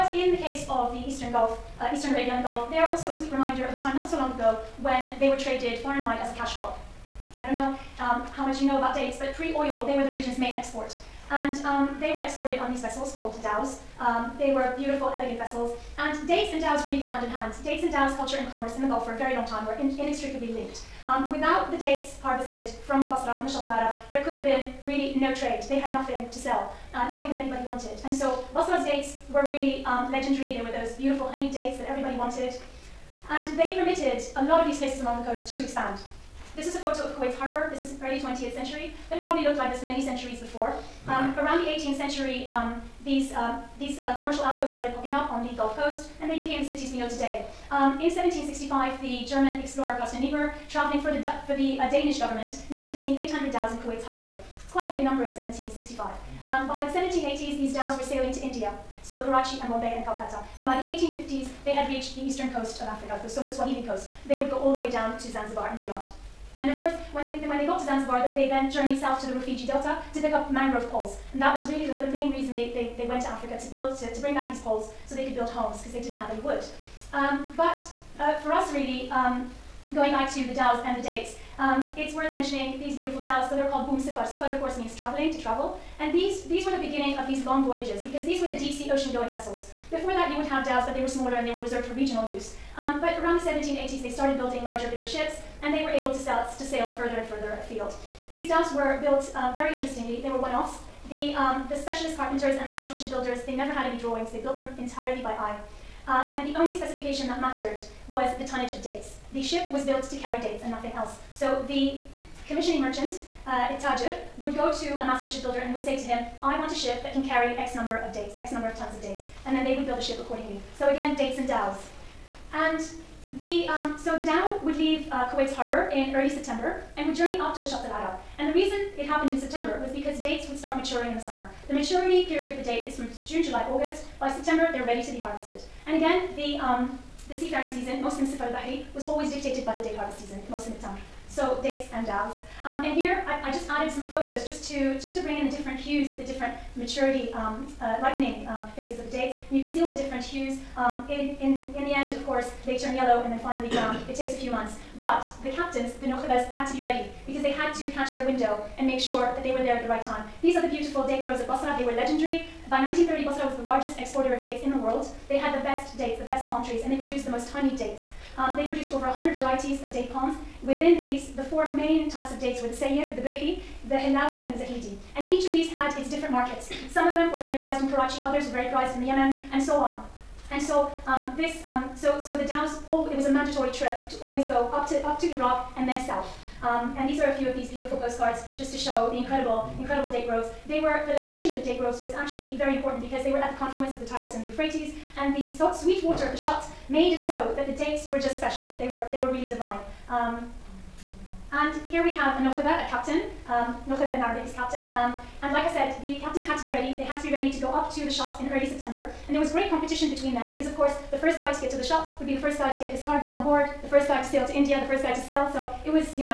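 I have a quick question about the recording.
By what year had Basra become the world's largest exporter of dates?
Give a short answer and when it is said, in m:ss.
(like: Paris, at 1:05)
1930, at 2:42.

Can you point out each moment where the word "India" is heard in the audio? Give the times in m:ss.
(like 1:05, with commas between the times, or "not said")
0:58, 3:34.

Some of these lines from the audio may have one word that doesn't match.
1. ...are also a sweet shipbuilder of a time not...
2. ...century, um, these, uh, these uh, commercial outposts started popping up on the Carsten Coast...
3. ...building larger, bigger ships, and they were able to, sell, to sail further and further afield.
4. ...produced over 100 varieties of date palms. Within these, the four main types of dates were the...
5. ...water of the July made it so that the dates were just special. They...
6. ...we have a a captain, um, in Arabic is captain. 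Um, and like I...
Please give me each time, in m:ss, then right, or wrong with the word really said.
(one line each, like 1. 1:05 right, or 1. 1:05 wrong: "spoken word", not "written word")
1. 0:02 wrong: "reminder", not "shipbuilder"
2. 0:41 wrong: "Gulf", not "Carsten"
3. 1:34 right
4. 2:48 right
5. 3:16 wrong: "Shatt", not "July"
6. 3:22 right.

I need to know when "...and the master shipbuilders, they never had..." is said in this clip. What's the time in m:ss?
1:42.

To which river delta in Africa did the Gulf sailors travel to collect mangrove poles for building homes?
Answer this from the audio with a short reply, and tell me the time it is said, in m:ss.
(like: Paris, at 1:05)
Rufiji Delta, at 1:09.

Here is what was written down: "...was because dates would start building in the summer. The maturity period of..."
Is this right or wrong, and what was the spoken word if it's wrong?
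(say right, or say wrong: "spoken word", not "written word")
wrong: "maturing", not "building".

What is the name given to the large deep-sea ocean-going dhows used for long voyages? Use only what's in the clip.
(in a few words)
boom sifar.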